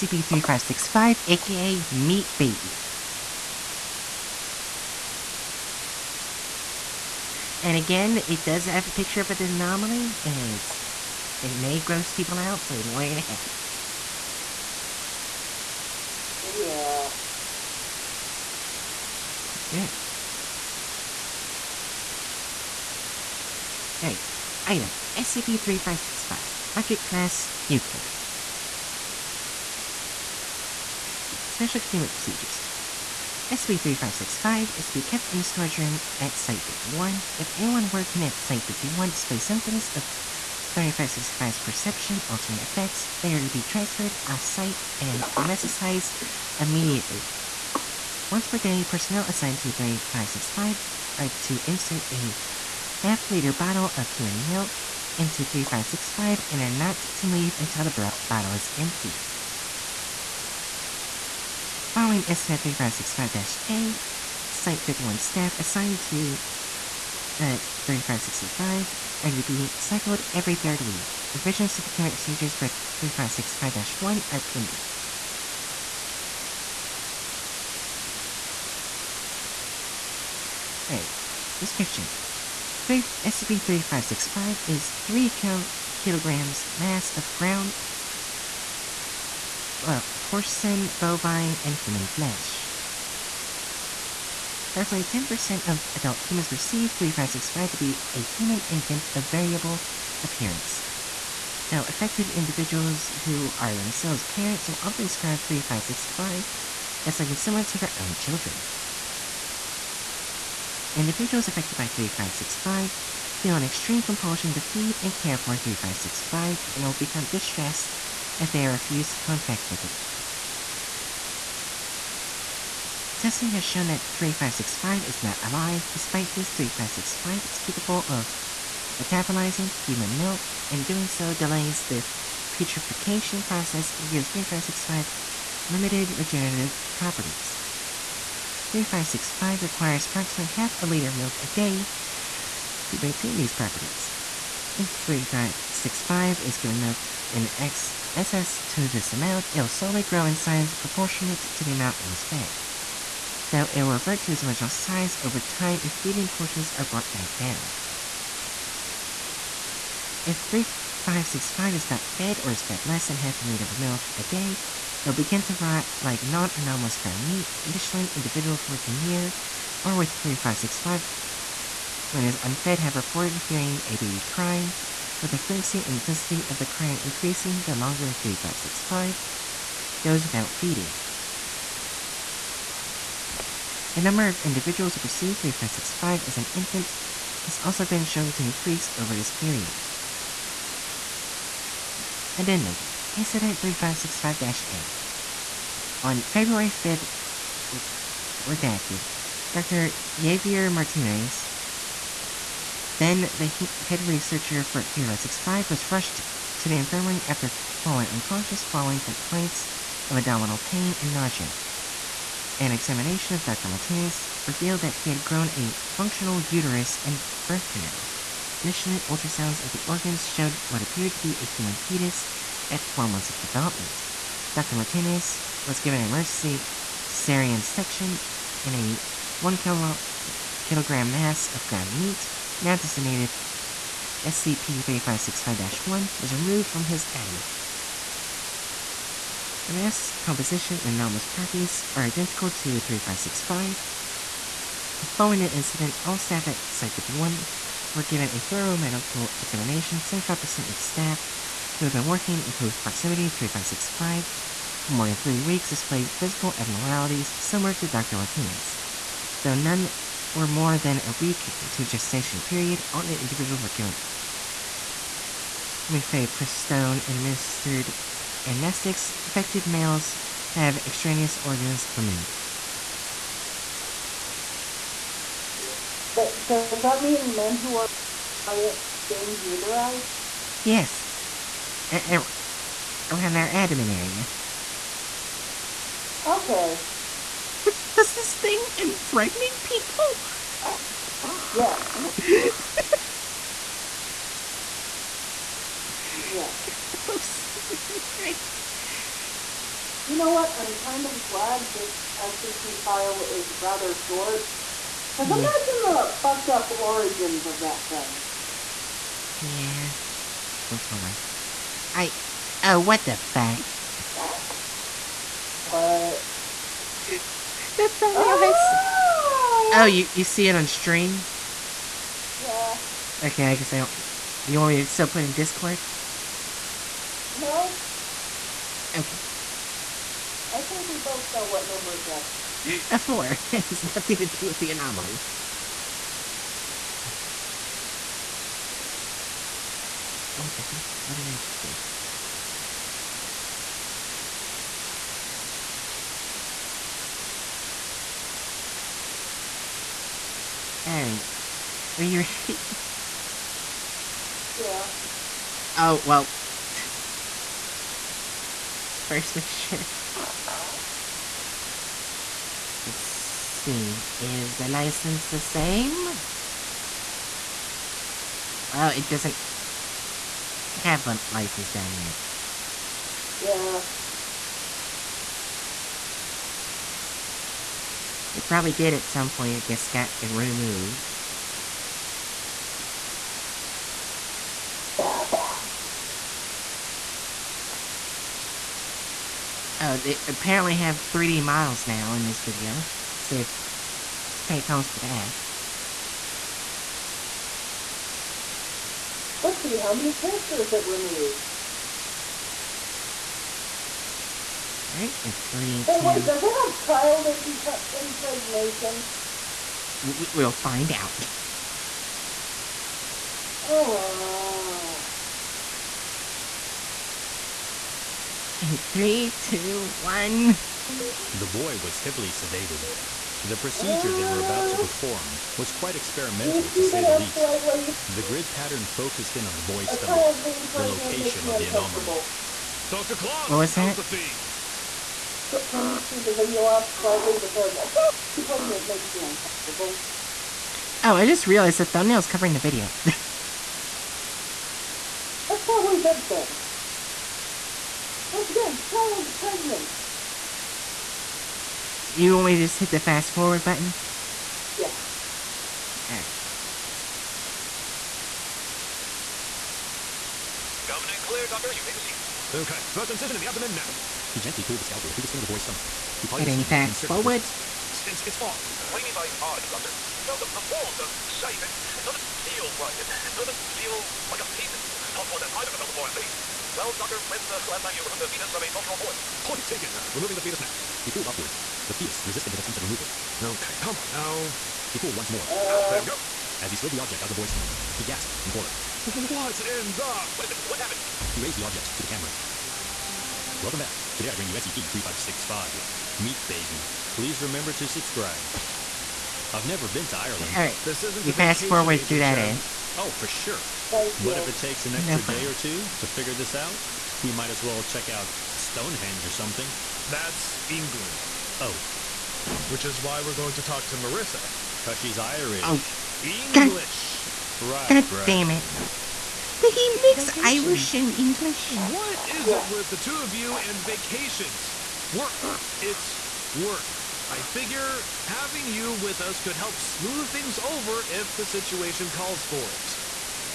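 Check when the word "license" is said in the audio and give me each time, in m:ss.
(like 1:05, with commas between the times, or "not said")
6:04, 6:11.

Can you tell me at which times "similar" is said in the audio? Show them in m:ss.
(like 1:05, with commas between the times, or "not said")
1:47, 4:17.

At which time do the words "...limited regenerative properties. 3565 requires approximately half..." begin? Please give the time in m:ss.
2:15.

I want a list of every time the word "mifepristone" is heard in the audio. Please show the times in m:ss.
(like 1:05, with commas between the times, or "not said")
4:25.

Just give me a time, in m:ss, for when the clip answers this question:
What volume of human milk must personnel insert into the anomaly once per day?
0:52.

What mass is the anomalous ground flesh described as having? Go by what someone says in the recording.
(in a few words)
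3 kilograms.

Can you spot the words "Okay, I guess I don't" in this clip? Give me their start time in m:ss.
5:23.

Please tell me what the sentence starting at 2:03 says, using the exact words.
Testing has shown that 3565 is not alive.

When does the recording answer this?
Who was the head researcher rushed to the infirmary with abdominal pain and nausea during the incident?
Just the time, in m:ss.
3:19.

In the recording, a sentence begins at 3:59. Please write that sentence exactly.
The mass composition and anomalous properties are identical to 3565.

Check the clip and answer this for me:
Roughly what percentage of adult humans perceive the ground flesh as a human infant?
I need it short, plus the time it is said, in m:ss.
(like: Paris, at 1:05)
10%, at 1:35.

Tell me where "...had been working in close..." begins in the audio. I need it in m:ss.
4:11.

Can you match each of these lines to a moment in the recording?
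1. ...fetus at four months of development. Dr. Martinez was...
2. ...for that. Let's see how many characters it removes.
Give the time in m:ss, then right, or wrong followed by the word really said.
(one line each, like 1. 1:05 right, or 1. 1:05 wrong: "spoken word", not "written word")
1. 3:41 right
2. 6:34 right.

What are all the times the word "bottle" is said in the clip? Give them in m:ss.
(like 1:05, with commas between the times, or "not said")
0:53, 0:58.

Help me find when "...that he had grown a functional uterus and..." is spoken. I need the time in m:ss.
3:34.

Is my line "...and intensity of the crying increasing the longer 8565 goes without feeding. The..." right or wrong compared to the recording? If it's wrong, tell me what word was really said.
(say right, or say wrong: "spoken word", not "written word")
wrong: "3565", not "8565".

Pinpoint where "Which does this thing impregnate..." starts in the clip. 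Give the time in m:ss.
4:47.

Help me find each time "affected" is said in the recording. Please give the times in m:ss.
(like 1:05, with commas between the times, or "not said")
1:41, 1:51, 4:29.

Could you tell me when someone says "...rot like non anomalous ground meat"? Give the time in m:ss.
2:45.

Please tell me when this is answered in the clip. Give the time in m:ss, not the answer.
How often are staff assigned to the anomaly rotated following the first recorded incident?
1:10.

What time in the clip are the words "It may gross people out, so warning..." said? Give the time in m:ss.
0:11.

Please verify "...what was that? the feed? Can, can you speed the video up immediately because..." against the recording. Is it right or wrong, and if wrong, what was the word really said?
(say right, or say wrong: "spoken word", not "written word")
wrong: "slightly", not "immediately".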